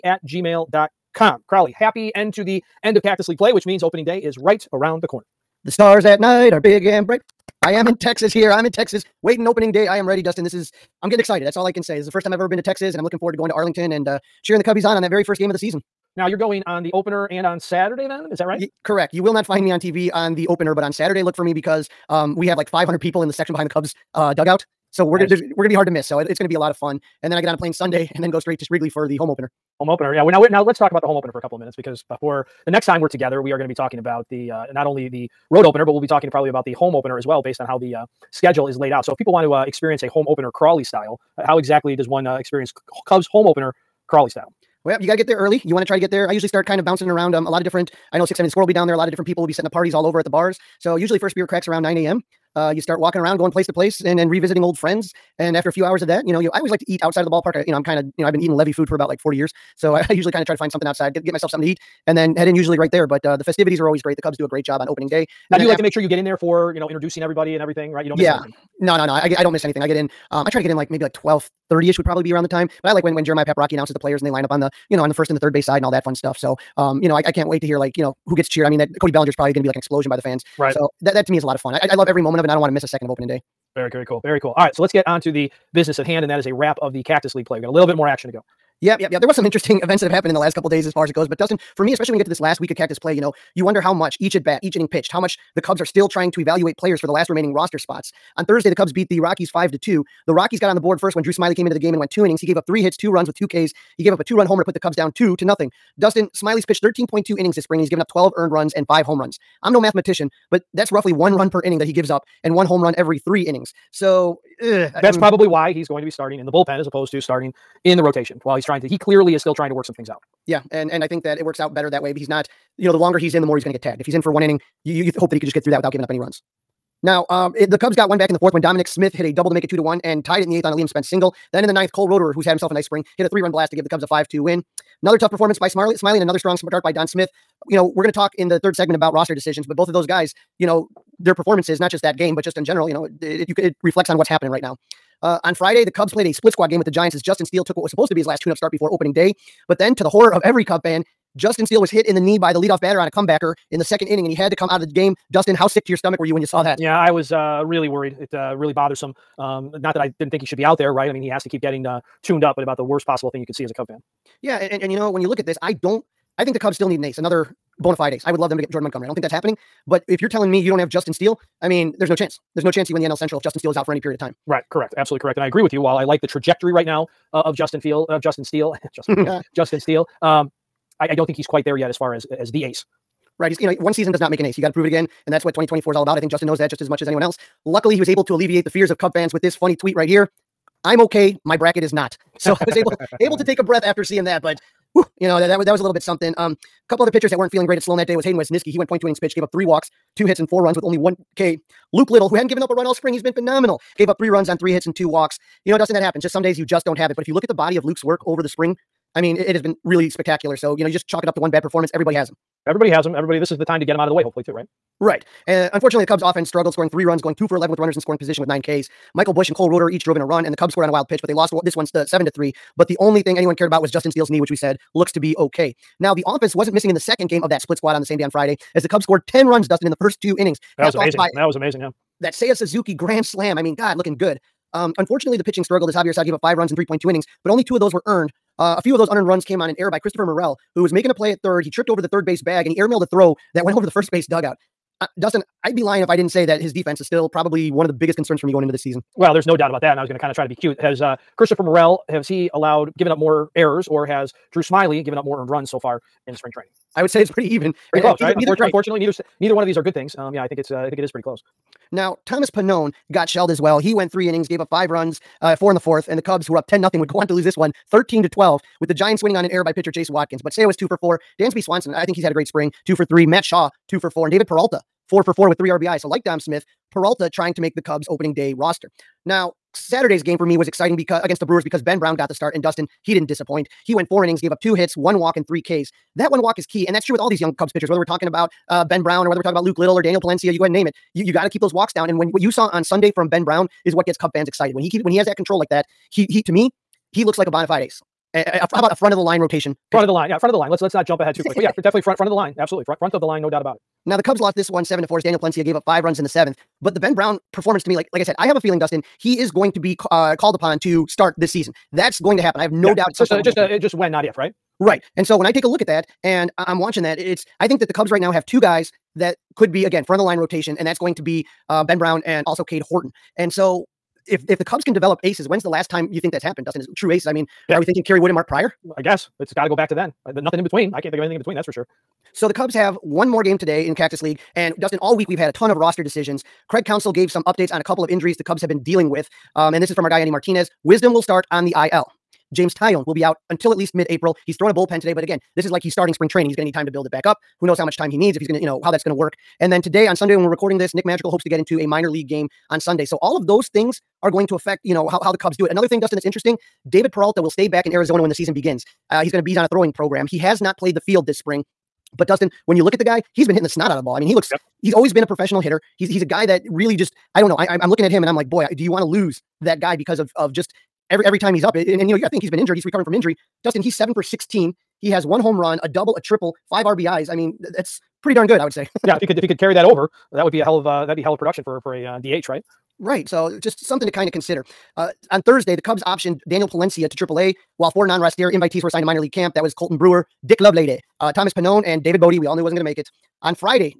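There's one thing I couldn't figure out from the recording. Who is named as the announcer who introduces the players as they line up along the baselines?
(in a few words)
Jeremiah Paprocki.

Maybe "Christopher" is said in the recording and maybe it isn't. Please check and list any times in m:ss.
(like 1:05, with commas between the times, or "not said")
3:59, 4:11.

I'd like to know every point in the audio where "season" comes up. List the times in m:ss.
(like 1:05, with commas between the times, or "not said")
0:15, 3:03, 4:08, 5:11, 5:58.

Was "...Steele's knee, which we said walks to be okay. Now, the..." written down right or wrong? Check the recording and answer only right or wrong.
wrong.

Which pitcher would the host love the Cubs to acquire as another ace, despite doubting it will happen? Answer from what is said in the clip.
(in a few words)
Jordan Montgomery.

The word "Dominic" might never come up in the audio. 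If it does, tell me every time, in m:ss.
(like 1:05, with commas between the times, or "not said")
2:08.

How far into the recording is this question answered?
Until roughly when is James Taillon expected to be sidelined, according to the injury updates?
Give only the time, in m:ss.
5:43.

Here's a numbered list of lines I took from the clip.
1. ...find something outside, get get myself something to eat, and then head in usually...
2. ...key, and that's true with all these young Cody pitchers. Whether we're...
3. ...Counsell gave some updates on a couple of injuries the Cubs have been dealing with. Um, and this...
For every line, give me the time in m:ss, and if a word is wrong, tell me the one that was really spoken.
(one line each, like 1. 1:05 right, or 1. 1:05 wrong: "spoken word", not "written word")
1. 1:00 right
2. 4:46 wrong: "Cubs", not "Cody"
3. 5:36 right.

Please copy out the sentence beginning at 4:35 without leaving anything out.
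So, like Dom Smith, Peralta trying to make the Cubs opening day roster.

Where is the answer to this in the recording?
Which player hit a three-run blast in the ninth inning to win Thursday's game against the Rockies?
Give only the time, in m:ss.
2:11.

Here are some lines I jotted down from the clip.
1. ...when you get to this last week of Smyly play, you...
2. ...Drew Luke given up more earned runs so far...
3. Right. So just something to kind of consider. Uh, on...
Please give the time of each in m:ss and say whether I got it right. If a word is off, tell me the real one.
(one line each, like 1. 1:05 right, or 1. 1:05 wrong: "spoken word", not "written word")
1. 1:32 wrong: "Cactus", not "Smyly"
2. 4:14 wrong: "Smyly", not "Luke"
3. 6:22 right.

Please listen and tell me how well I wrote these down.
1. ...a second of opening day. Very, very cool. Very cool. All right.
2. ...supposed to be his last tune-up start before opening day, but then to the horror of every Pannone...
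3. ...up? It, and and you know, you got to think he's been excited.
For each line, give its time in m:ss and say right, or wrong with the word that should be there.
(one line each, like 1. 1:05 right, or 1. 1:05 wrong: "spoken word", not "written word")
1. 1:22 right
2. 2:27 wrong: "Cub", not "Pannone"
3. 6:11 wrong: "injured", not "excited".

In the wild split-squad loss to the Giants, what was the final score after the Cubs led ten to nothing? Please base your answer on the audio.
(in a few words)
13 to 12.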